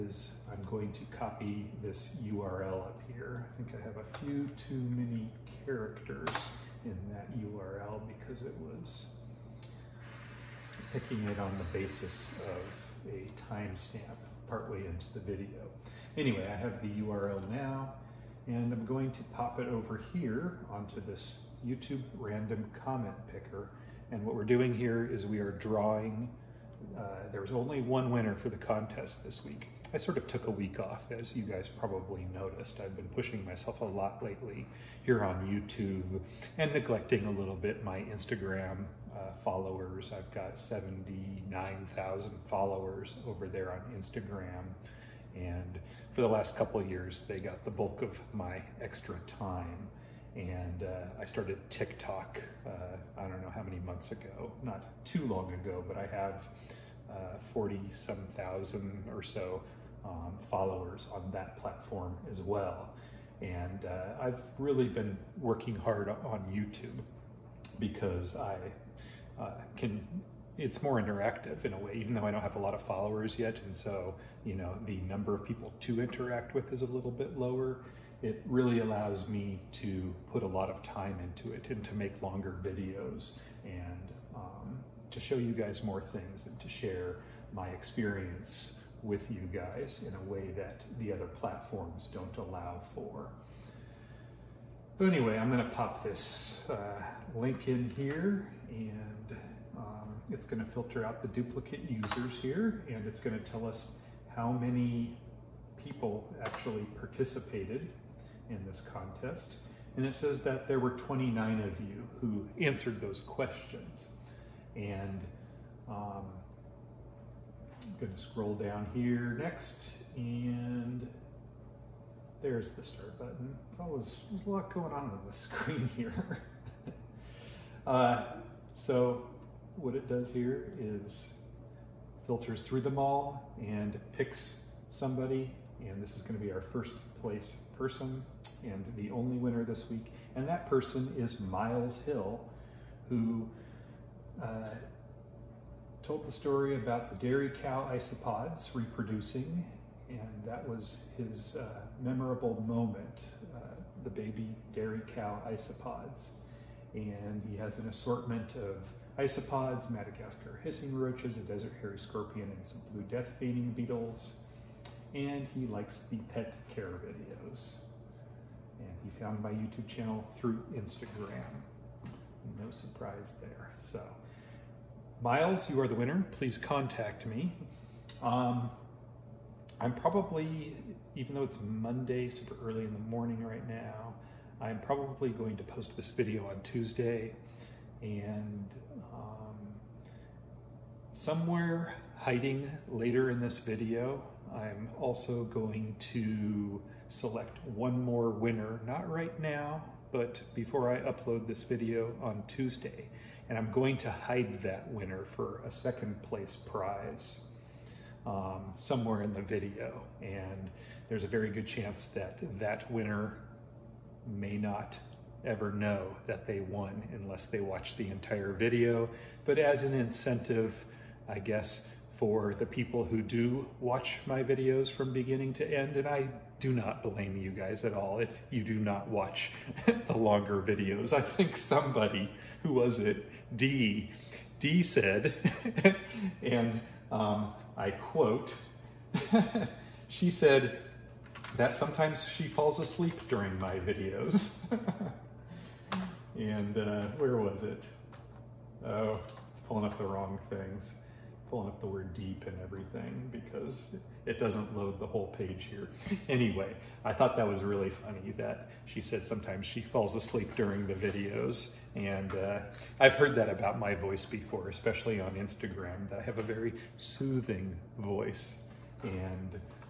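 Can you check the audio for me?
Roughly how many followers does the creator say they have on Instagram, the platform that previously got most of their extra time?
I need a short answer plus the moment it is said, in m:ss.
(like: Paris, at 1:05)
79,000, at 0:40.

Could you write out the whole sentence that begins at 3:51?
I think somebody, who was it?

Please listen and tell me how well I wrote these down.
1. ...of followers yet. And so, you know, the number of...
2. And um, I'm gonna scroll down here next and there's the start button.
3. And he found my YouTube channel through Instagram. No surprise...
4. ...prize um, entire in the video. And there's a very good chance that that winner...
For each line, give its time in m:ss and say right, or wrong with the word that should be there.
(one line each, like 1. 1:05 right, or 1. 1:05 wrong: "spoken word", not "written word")
1. 1:12 right
2. 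1:54 right
3. 2:48 right
4. 3:26 wrong: "somewhere", not "entire".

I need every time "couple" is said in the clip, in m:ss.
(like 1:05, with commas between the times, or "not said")
0:46.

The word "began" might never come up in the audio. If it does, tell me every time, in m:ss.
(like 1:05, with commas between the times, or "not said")
not said.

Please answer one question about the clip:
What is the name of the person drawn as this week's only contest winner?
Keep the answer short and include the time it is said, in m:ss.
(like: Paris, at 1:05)
Miles Hill, at 2:21.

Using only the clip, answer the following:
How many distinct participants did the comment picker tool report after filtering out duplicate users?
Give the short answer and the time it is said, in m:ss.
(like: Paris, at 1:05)
29, at 1:50.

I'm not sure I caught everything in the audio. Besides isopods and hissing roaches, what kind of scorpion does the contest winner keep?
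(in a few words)
desert hairy scorpion.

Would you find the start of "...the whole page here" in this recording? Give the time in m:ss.
4:15.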